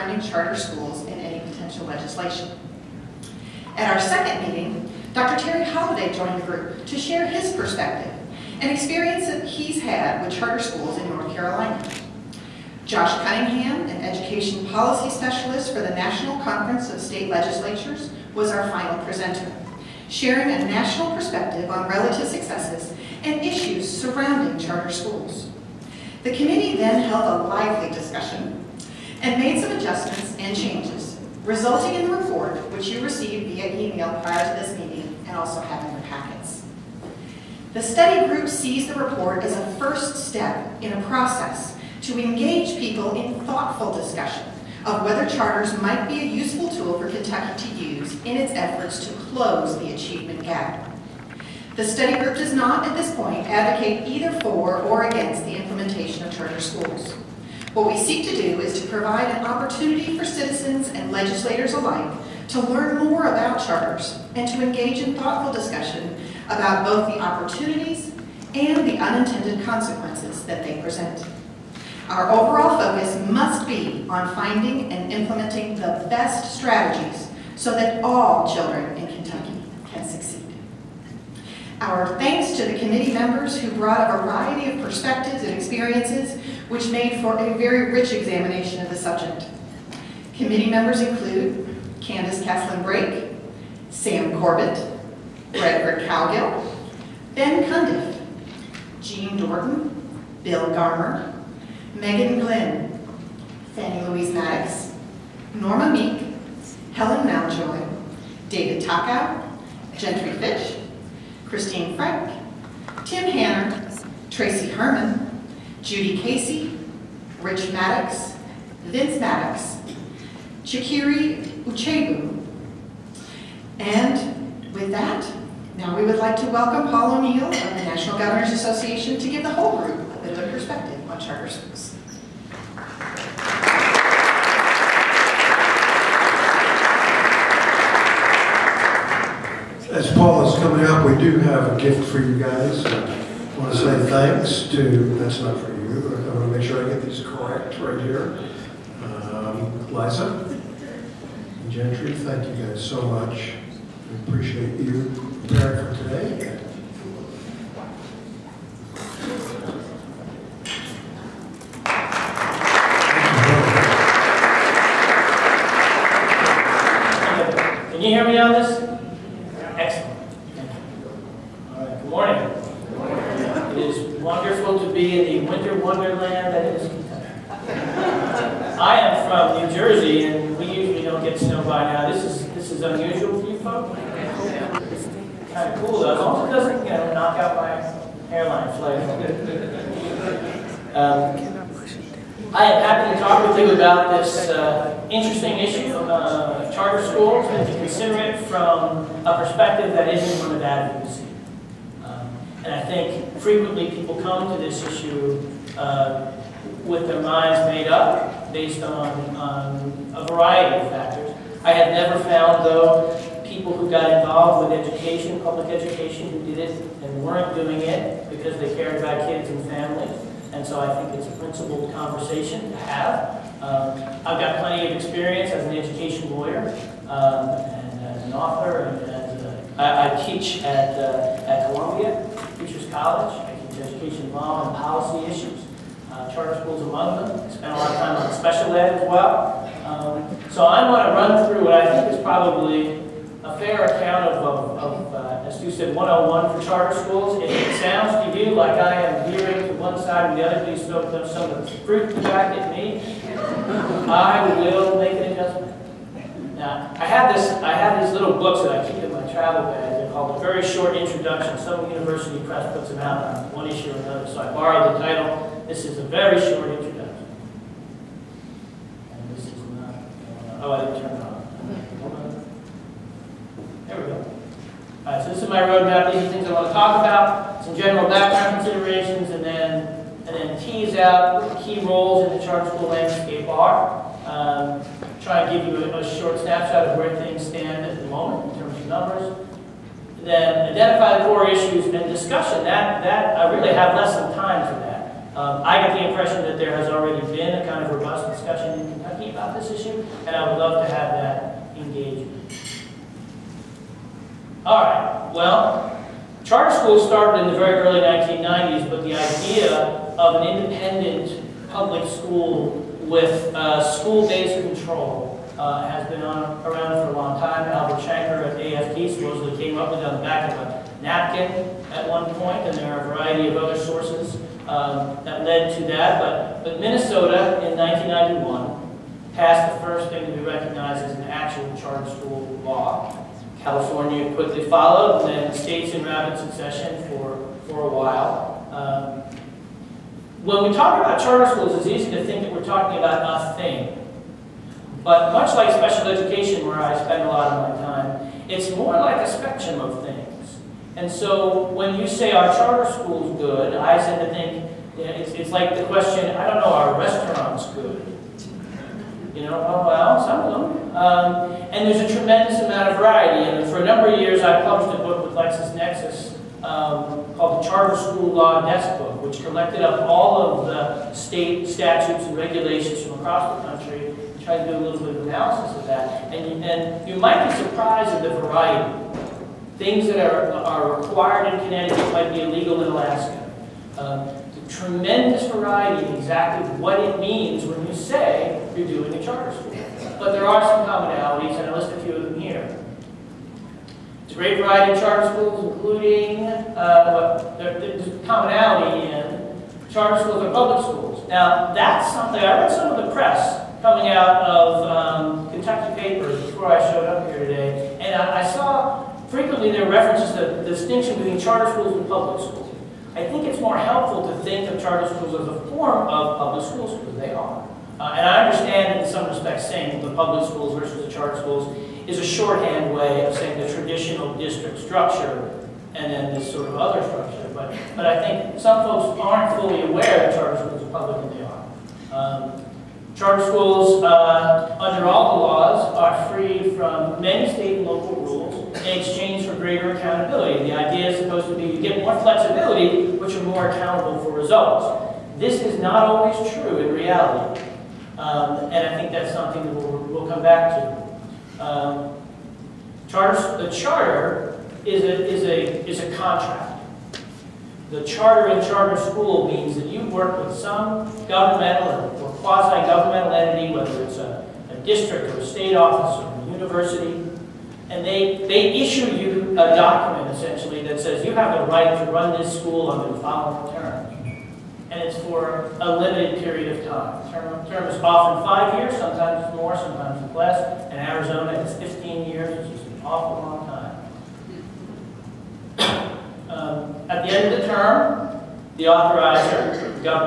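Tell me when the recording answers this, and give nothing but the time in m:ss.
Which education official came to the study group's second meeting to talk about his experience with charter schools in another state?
0:05.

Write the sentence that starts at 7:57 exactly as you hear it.
Term, term is often five years, sometimes more, sometimes less.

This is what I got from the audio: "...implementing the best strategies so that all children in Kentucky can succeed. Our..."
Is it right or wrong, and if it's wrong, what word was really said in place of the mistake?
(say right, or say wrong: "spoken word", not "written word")
right.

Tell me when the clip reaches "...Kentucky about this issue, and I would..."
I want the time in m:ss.
4:58.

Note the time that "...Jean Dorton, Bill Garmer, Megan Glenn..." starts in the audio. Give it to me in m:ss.
1:39.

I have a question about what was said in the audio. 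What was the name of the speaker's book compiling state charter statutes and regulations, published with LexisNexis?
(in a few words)
Charter School Law Desk Book.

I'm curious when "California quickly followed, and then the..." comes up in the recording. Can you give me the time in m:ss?
5:33.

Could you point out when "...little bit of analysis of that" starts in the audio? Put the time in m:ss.
6:14.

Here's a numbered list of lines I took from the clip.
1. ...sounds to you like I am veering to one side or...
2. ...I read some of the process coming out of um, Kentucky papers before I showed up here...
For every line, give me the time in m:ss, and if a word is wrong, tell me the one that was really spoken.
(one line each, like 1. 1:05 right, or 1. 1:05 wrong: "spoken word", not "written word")
1. 4:07 right
2. 6:42 wrong: "press", not "process".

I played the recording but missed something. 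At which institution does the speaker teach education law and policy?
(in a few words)
Columbia Teachers College.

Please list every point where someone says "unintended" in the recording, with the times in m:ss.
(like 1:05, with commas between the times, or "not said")
1:08.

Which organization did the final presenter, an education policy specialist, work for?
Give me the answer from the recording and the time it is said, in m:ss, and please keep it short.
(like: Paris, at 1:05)
National Conference of State Legislatures, at 0:15.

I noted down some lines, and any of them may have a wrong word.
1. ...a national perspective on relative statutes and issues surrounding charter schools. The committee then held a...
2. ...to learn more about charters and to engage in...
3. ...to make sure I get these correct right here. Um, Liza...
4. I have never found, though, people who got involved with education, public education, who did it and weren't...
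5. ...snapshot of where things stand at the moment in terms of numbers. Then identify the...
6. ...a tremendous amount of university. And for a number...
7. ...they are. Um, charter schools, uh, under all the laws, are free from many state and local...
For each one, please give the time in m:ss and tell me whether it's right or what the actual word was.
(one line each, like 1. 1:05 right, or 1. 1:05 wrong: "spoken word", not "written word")
1. 0:20 wrong: "successes", not "statutes"
2. 1:02 right
3. 2:26 right
4. 3:31 right
5. 4:46 right
6. 6:02 wrong: "variety", not "university"
7. 7:11 right.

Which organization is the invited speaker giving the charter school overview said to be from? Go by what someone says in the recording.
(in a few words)
National Governors Association.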